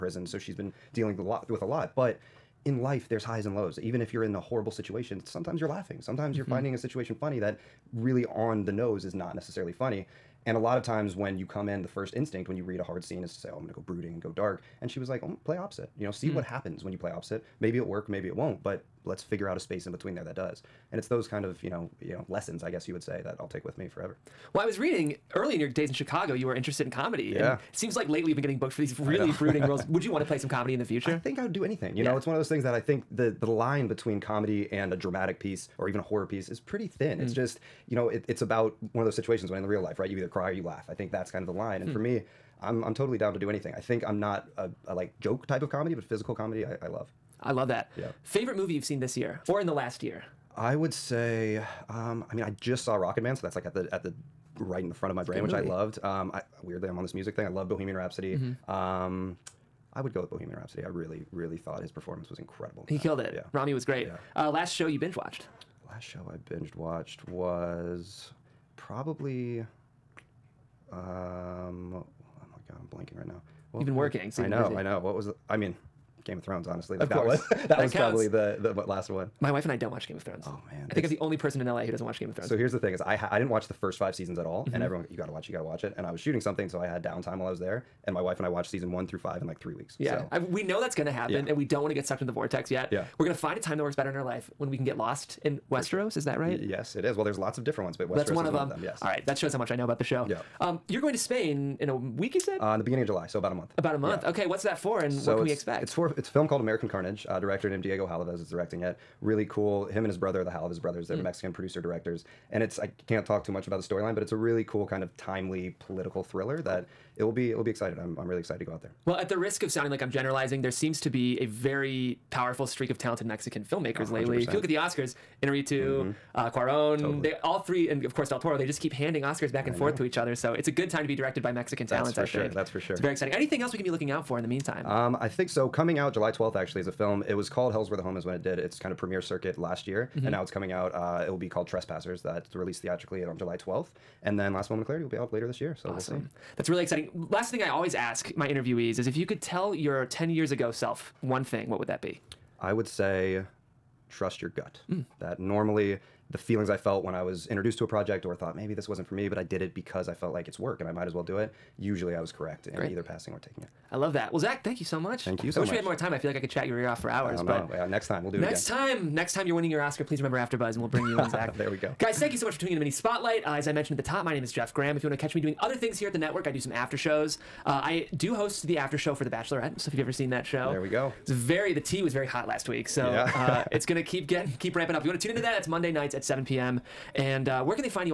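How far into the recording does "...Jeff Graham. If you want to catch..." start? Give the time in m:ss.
2:54.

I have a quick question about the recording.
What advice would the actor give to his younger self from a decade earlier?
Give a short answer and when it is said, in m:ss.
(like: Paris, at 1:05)
Trust your gut, at 2:34.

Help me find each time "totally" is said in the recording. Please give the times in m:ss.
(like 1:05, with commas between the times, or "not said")
0:42, 2:06.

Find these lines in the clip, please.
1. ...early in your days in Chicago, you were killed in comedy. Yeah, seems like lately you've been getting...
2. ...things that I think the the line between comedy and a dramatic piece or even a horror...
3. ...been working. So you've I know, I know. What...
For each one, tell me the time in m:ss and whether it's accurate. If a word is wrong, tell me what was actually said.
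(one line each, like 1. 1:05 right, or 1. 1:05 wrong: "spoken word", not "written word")
1. 0:25 wrong: "interested", not "killed"
2. 0:32 right
3. 1:13 right.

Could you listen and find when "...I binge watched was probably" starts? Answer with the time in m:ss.
1:06.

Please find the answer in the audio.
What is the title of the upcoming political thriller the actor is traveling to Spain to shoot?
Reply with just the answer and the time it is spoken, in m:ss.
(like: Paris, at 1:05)
American Carnage, at 1:46.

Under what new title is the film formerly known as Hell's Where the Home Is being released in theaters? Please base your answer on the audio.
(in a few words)
Trespassers.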